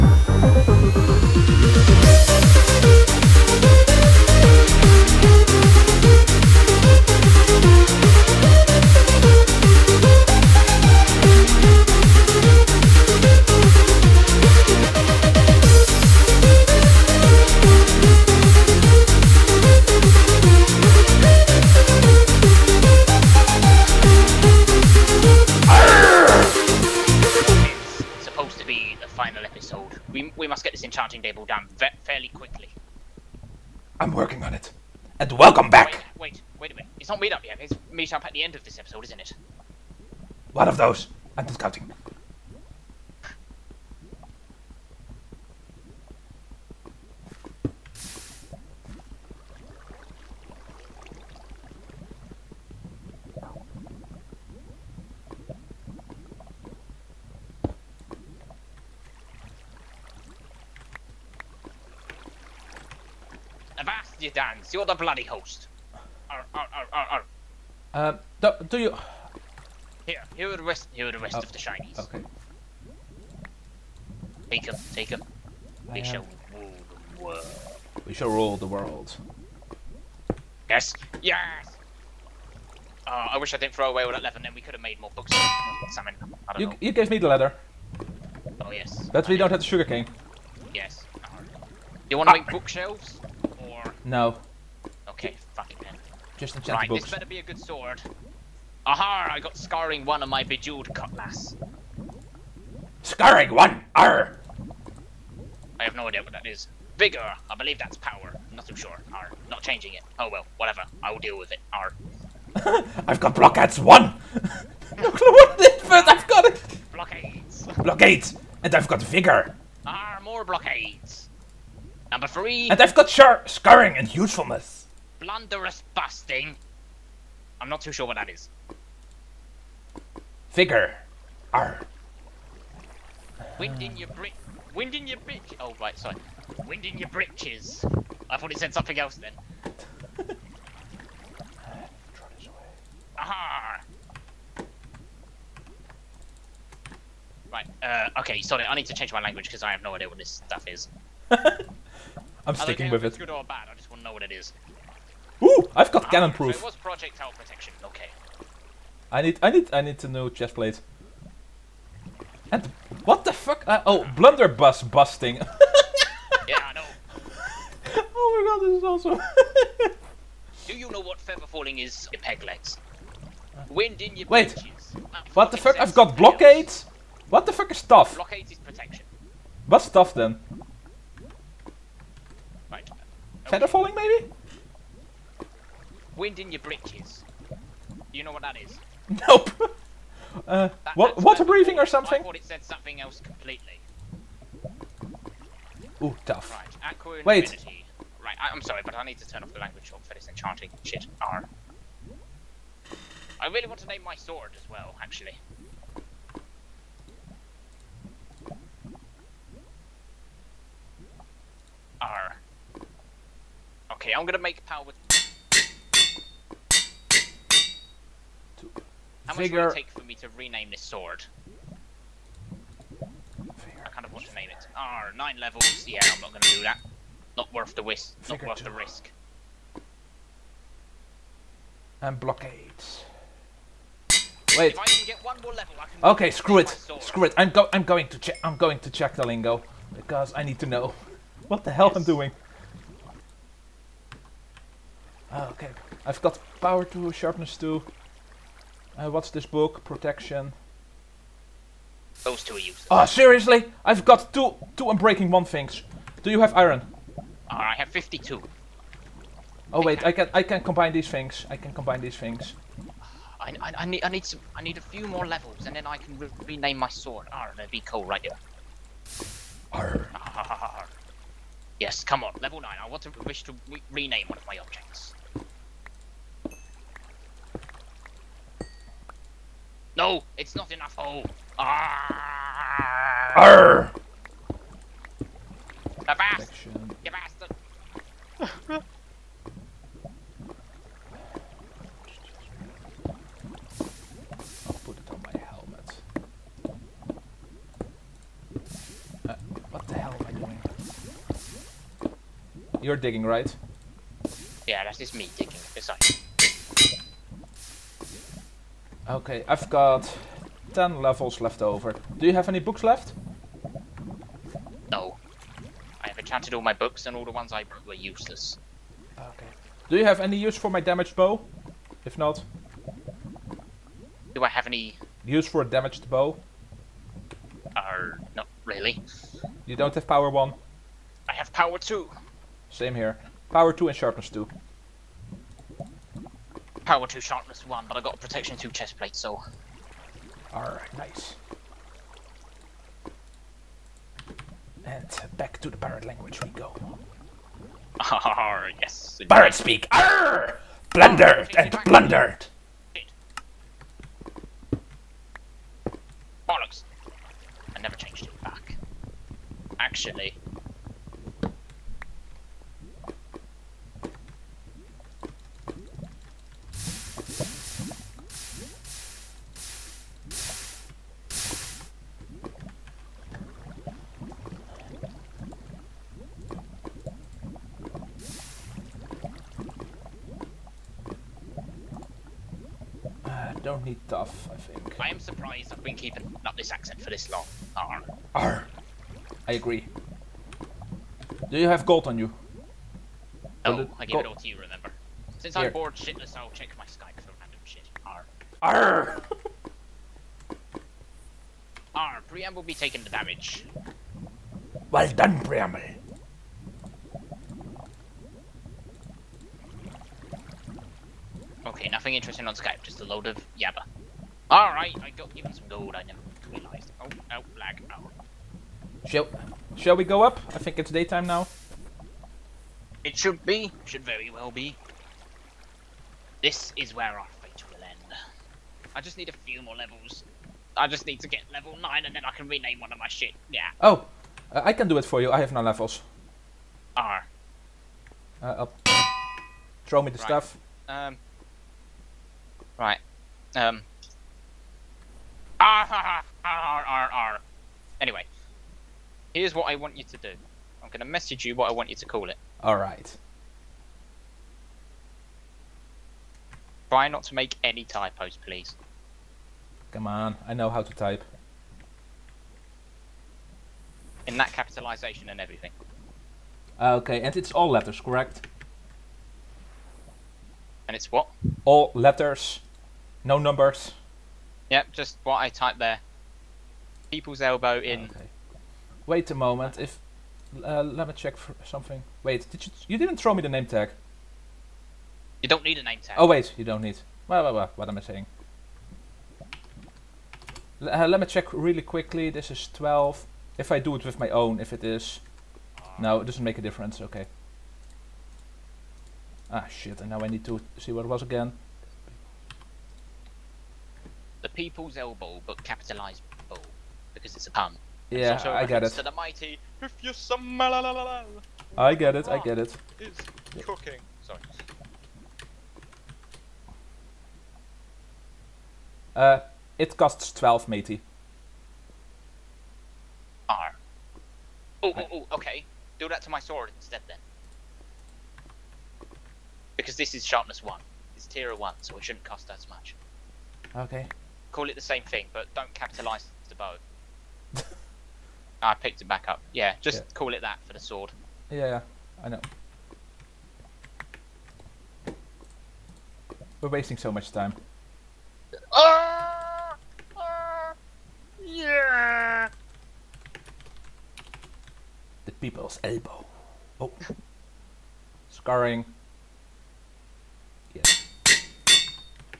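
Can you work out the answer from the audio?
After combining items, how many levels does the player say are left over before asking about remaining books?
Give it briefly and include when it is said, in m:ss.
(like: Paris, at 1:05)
10, at 5:10.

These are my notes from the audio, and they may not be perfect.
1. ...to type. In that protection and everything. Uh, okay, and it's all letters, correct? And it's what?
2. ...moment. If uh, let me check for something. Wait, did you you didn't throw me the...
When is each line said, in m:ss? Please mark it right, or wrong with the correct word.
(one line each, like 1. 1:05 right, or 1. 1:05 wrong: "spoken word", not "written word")
1. 7:40 wrong: "capitalization", not "protection"
2. 7:59 right.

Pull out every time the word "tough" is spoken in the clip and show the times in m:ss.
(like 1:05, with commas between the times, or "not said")
3:16, 6:24.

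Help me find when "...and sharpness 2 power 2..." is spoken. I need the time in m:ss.
5:33.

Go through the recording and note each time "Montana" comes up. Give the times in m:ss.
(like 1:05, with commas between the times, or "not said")
not said.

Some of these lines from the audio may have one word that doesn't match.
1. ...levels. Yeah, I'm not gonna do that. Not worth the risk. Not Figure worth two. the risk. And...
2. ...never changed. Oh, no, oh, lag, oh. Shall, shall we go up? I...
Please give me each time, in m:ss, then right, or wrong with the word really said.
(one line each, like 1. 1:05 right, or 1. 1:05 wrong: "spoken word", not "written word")
1. 3:45 right
2. 6:56 wrong: "realised", not "changed".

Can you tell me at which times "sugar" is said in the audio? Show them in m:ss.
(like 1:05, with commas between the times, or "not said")
1:29.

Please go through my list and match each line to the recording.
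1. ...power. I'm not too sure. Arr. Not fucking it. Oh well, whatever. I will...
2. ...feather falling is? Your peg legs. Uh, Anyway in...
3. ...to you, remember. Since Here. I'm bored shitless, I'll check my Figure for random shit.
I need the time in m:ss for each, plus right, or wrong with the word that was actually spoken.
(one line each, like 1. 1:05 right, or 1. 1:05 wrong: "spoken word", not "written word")
1. 1:47 wrong: "changing", not "fucking"
2. 2:51 wrong: "Wind", not "Anyway"
3. 6:34 wrong: "Skype", not "Figure".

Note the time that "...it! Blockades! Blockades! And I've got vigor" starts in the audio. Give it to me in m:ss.
1:56.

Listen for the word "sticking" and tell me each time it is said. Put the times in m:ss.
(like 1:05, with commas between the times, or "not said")
2:32.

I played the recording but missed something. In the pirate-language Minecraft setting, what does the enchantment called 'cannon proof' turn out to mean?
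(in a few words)
Projectile protection.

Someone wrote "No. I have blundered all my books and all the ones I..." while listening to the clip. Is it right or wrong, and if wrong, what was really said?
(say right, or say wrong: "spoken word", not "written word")
wrong: "enchanted", not "blundered".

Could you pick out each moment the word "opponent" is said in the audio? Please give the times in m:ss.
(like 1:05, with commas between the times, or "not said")
not said.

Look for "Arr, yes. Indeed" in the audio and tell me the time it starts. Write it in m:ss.
5:48.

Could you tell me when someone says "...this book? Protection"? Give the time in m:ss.
4:09.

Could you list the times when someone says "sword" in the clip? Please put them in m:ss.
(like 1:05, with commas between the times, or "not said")
1:37, 3:24, 3:40, 4:26, 8:46, 9:00.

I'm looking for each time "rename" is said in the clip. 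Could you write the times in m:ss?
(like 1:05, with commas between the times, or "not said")
3:40, 4:26, 4:33, 7:12.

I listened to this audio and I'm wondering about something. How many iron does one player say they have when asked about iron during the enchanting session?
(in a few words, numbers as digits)
52.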